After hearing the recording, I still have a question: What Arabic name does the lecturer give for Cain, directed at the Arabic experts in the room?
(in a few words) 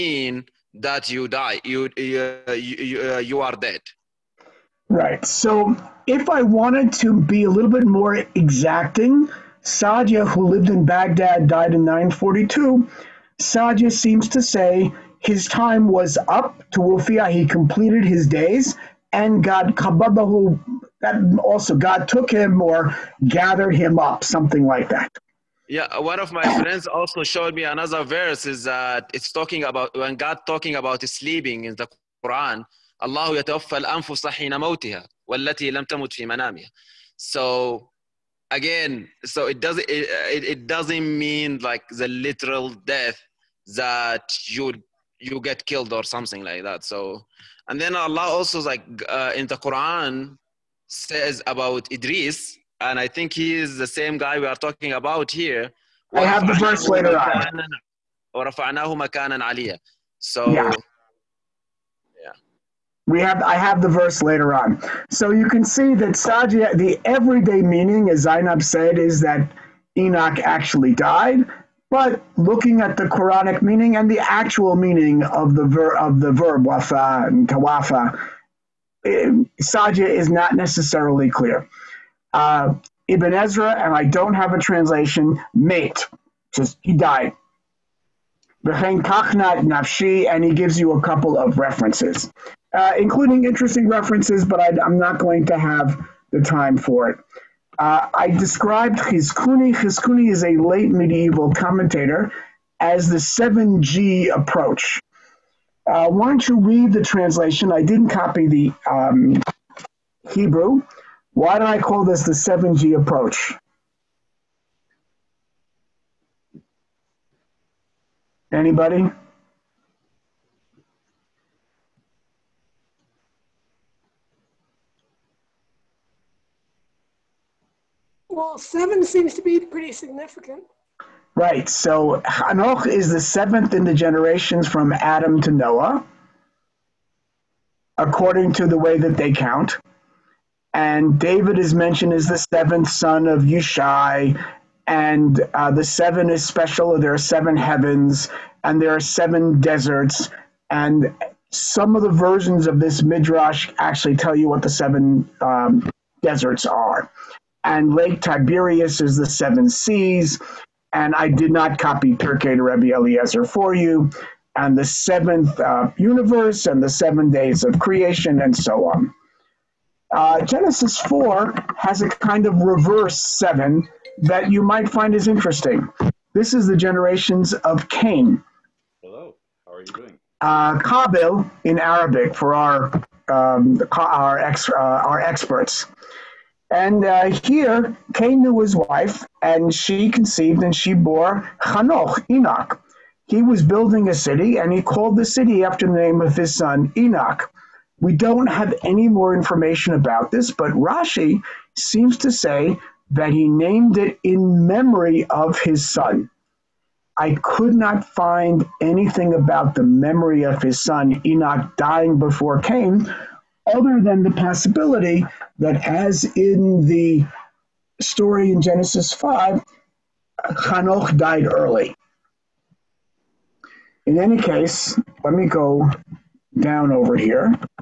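Kabil.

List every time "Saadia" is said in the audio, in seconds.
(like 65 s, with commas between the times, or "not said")
66 s, 79 s.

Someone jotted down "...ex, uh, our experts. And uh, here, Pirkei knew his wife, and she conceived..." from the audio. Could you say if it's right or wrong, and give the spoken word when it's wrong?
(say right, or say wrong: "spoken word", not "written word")
wrong: "Cain", not "Pirkei".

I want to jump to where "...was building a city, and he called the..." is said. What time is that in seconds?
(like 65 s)
193 s.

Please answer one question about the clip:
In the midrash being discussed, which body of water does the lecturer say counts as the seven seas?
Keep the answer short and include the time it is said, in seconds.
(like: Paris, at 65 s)
Lake Tiberias, at 157 s.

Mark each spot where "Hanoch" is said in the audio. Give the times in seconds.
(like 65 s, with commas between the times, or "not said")
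132 s, 191 s, 220 s.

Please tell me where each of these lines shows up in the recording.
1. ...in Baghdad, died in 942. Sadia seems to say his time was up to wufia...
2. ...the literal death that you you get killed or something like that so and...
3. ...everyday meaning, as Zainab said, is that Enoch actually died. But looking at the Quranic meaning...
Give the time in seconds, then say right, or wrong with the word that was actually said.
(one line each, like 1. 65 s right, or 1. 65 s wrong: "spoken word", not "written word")
1. 10 s right
2. 41 s right
3. 67 s right.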